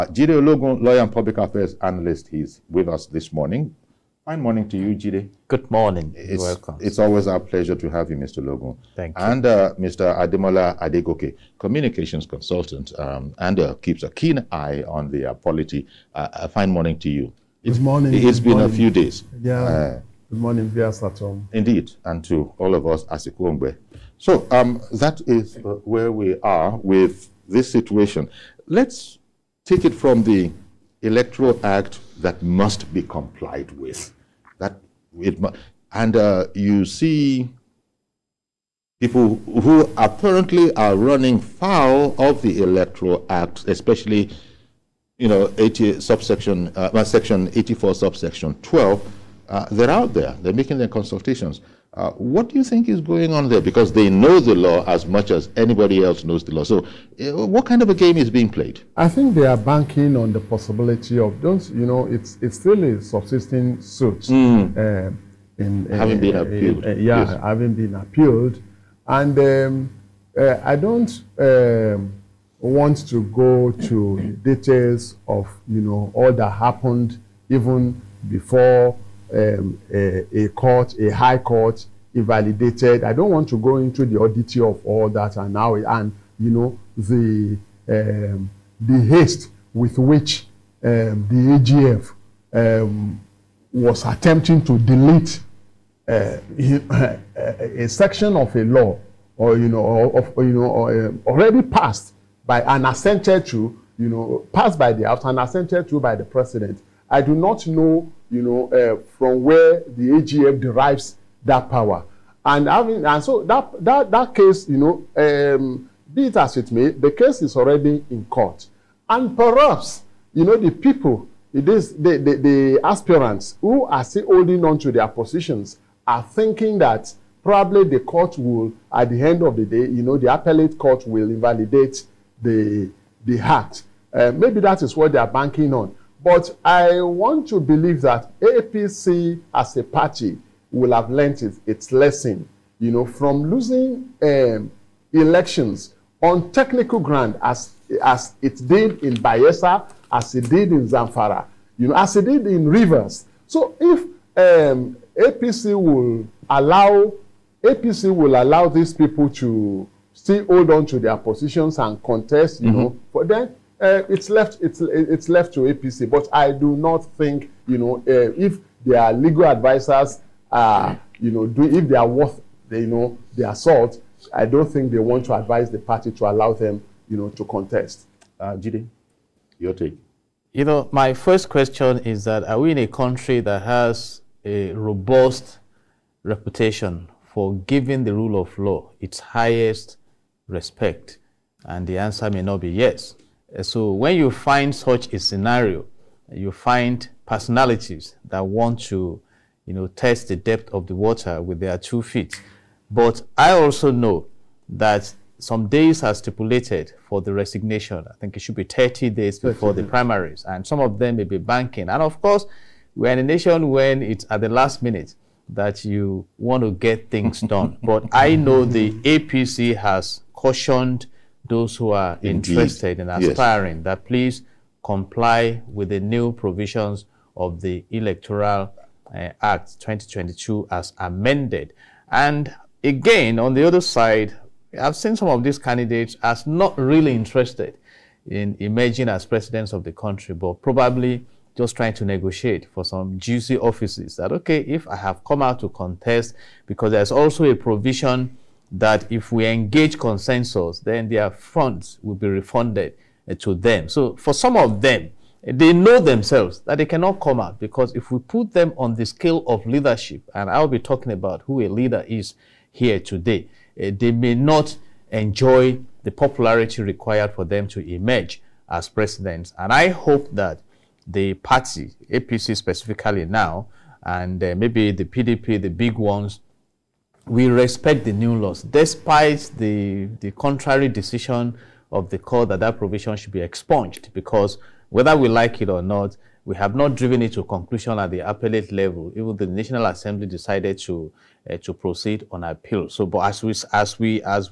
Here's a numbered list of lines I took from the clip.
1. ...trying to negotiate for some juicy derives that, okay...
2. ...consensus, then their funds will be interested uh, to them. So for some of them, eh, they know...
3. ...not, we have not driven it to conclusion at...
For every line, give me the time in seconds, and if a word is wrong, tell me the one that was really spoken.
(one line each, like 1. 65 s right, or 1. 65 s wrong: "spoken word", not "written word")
1. 241 s wrong: "offices", not "derives"
2. 249 s wrong: "refunded", not "interested"
3. 285 s right.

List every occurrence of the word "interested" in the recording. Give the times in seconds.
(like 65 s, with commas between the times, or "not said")
222 s, 237 s.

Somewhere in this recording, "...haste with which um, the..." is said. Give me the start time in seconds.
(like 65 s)
89 s.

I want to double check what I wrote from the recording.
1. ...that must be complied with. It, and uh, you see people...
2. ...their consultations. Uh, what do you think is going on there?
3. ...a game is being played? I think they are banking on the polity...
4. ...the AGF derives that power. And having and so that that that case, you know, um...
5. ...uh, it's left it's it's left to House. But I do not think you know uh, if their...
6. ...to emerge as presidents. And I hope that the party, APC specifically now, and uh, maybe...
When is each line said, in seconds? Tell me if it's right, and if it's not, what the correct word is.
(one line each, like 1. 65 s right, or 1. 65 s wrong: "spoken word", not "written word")
1. 32 s right
2. 50 s right
3. 57 s wrong: "possibility", not "polity"
4. 109 s right
5. 163 s wrong: "APC", not "House"
6. 267 s right.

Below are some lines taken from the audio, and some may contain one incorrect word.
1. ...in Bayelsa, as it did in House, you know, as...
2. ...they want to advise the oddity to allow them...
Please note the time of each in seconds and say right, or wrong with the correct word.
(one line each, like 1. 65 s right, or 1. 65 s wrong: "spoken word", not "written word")
1. 149 s wrong: "Zamfara", not "House"
2. 174 s wrong: "party", not "oddity".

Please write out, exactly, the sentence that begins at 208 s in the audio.
I think it should be 30 days before the primaries, and some of them may be banking.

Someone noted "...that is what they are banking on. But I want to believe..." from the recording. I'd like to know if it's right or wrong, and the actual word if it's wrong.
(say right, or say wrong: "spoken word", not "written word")
right.